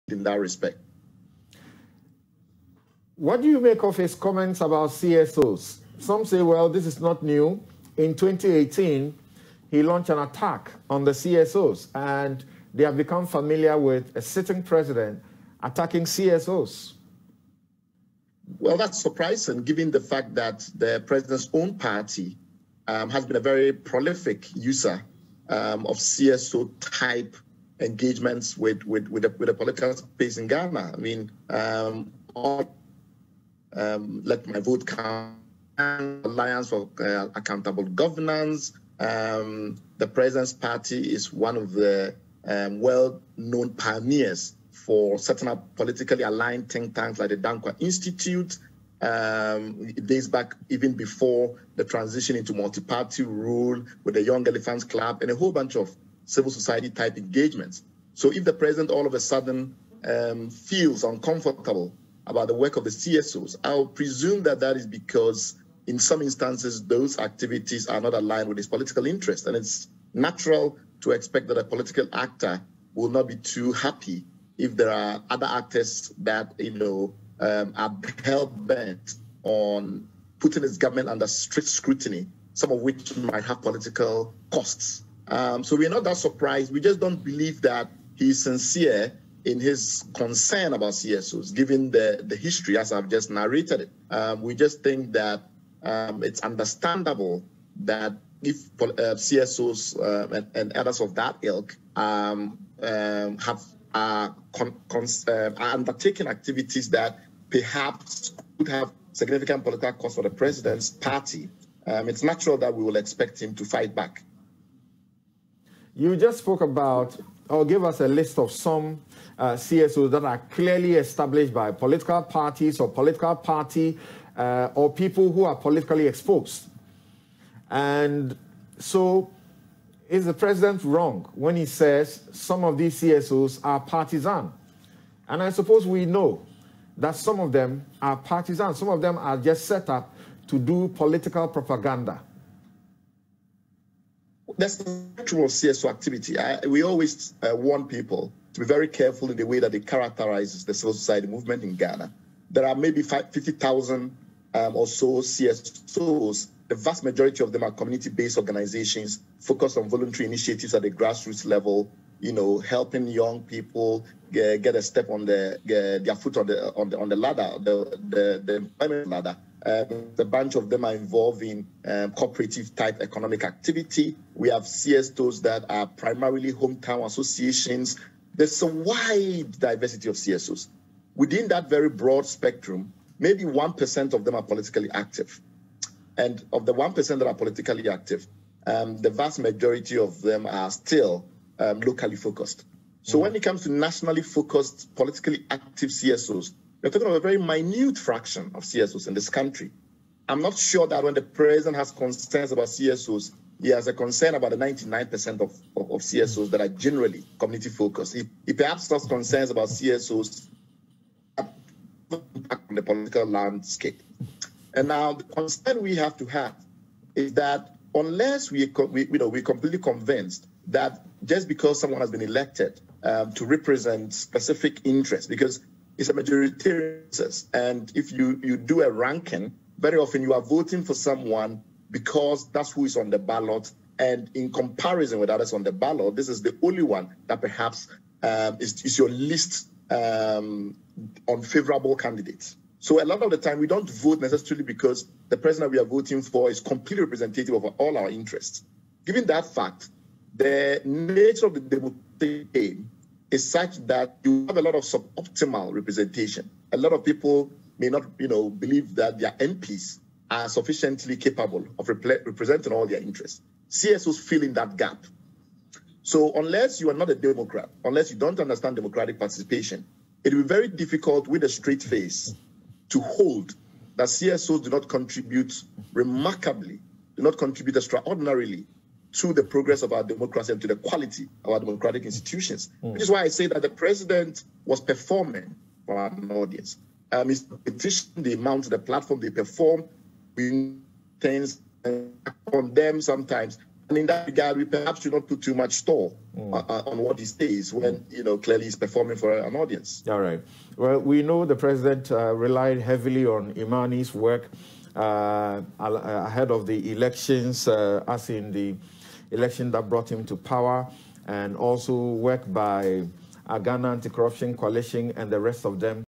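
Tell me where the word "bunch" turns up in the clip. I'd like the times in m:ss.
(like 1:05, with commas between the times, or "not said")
0:55, 2:50.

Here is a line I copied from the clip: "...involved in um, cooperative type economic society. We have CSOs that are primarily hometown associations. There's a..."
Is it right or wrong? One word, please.
wrong.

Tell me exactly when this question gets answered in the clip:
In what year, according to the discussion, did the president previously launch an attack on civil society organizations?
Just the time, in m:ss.
0:08.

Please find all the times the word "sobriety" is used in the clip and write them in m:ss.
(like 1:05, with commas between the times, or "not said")
not said.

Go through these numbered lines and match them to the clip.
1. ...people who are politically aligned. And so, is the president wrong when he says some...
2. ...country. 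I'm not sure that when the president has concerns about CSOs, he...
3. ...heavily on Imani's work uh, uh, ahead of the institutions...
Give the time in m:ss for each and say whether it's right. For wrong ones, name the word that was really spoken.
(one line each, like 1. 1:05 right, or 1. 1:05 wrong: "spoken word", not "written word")
1. 2:04 wrong: "exposed", not "aligned"
2. 3:19 right
3. 5:02 wrong: "elections", not "institutions".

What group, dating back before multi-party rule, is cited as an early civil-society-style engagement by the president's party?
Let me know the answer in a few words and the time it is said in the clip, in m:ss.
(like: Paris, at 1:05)
Young Elephants Club, at 0:54.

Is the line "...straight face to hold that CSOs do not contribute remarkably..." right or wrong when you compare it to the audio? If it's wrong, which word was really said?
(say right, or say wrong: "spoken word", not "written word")
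right.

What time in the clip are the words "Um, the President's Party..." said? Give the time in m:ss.
0:38.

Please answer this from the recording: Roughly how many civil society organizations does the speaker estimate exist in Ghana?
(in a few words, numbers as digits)
50,000.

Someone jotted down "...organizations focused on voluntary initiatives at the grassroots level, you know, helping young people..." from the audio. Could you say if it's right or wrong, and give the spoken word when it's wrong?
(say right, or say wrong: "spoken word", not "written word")
right.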